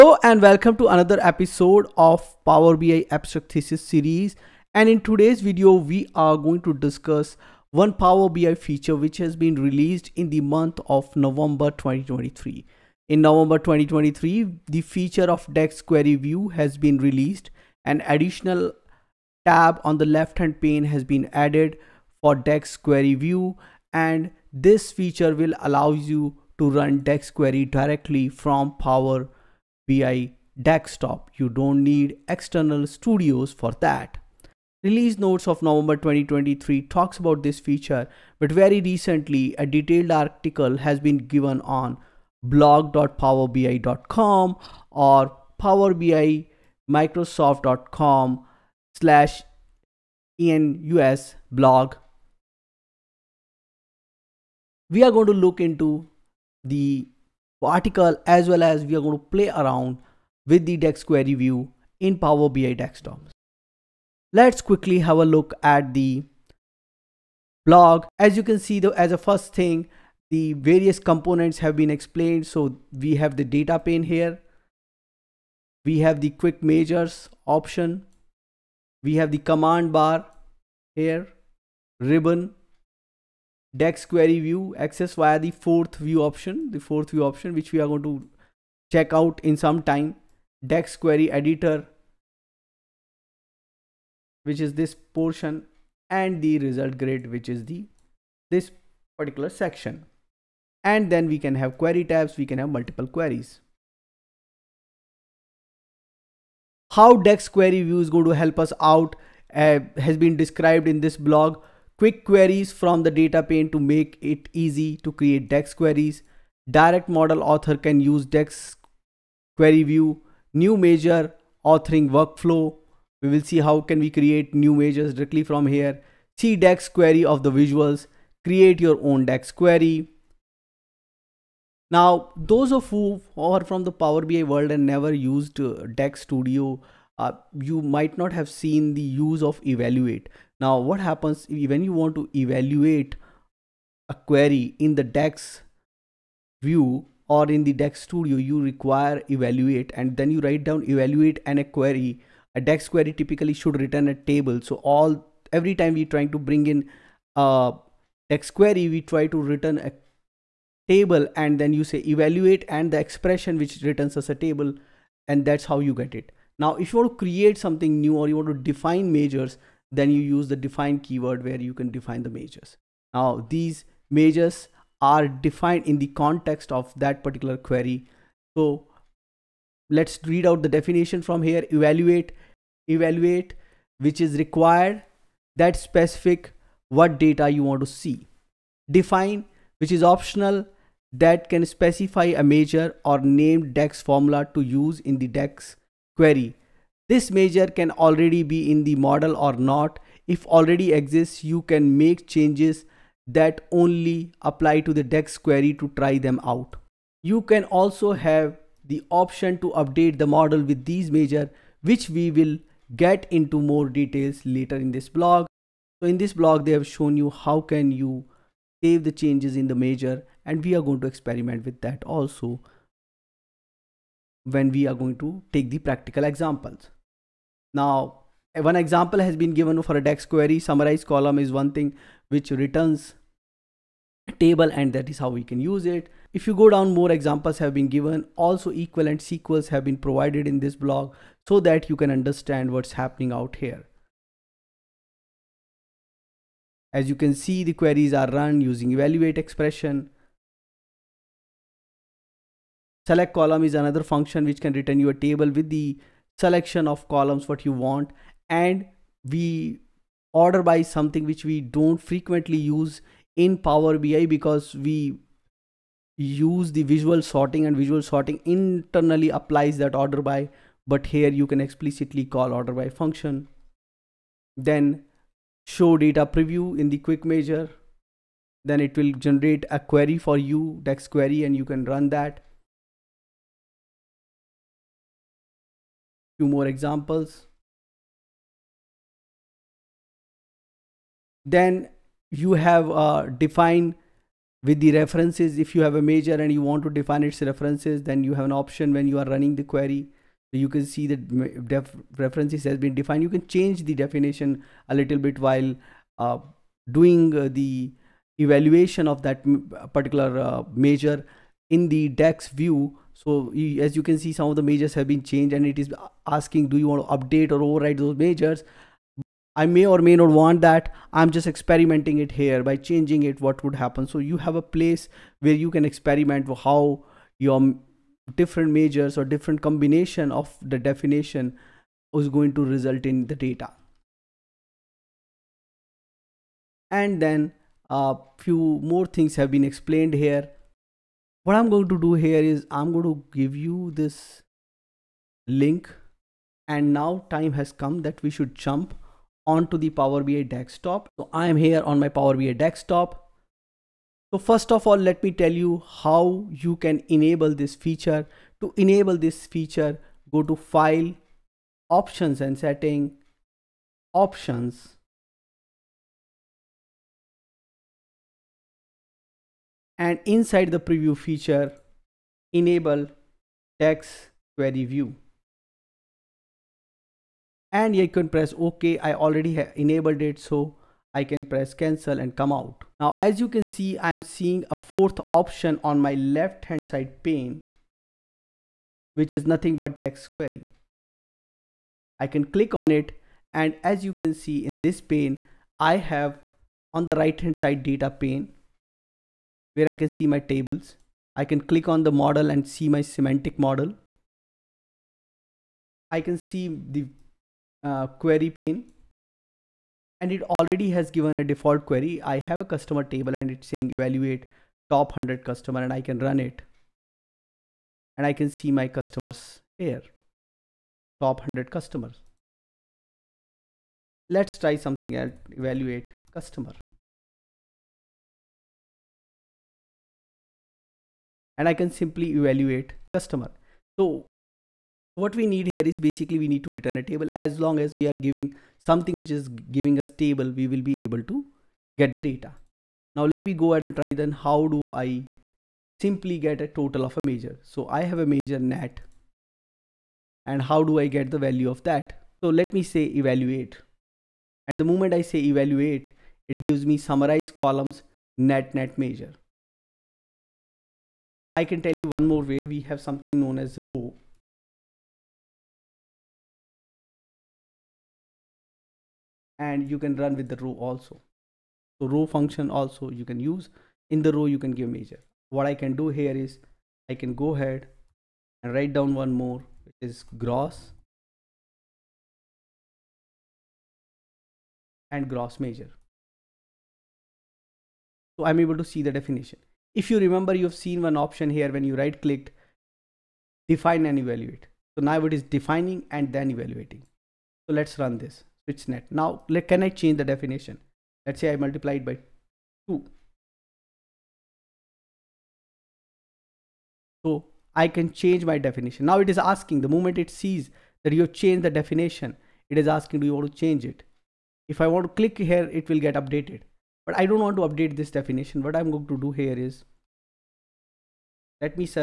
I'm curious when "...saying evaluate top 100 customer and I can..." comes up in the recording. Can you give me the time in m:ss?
6:53.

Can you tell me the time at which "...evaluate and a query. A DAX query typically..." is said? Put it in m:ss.
2:30.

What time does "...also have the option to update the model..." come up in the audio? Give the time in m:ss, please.
3:27.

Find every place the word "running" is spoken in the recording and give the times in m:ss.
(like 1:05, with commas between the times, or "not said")
4:59.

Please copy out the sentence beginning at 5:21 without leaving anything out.
I'm just experimenting it here by changing it.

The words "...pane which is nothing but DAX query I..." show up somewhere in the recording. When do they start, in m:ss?
6:27.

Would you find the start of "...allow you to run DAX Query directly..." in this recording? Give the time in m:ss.
0:25.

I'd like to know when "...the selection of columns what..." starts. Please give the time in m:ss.
4:15.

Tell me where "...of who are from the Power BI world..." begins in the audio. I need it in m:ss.
2:12.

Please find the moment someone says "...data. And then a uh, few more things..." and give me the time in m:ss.
5:33.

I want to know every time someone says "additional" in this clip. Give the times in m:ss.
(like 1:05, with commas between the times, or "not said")
0:18.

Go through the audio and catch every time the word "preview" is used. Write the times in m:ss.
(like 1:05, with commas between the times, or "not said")
4:36, 6:10.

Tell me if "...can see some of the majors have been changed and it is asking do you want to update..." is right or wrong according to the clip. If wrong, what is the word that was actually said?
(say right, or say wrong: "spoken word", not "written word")
right.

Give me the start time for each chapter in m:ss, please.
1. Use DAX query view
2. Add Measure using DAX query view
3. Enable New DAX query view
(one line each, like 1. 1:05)
1. 6:59
2. 8:29
3. 5:59.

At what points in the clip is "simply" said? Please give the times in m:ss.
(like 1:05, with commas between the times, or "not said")
7:11, 7:25.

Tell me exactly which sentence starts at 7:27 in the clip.
So I have a major net and how do I get the value of that?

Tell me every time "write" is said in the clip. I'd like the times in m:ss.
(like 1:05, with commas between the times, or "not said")
2:30, 7:58.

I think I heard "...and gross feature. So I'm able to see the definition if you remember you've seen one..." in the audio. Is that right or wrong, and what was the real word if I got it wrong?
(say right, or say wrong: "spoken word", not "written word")
wrong: "measure", not "feature".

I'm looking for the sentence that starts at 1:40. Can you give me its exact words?
And then we can have query tabs, we can have multiple queries.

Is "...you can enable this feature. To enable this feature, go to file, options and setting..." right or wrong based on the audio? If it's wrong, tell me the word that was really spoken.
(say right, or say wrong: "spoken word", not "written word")
right.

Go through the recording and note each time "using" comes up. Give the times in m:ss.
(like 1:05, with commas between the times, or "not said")
4:08.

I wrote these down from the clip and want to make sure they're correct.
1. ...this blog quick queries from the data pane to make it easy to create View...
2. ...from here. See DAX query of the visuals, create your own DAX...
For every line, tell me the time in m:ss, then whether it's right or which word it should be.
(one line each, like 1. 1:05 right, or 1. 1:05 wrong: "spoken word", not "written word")
1. 1:51 wrong: "DAX", not "View"
2. 2:05 right.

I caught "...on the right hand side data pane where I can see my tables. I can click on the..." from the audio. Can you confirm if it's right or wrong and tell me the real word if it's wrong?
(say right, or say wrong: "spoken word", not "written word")
right.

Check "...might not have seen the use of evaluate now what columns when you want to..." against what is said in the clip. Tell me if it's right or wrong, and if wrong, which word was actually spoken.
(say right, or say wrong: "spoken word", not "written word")
wrong: "happens", not "columns".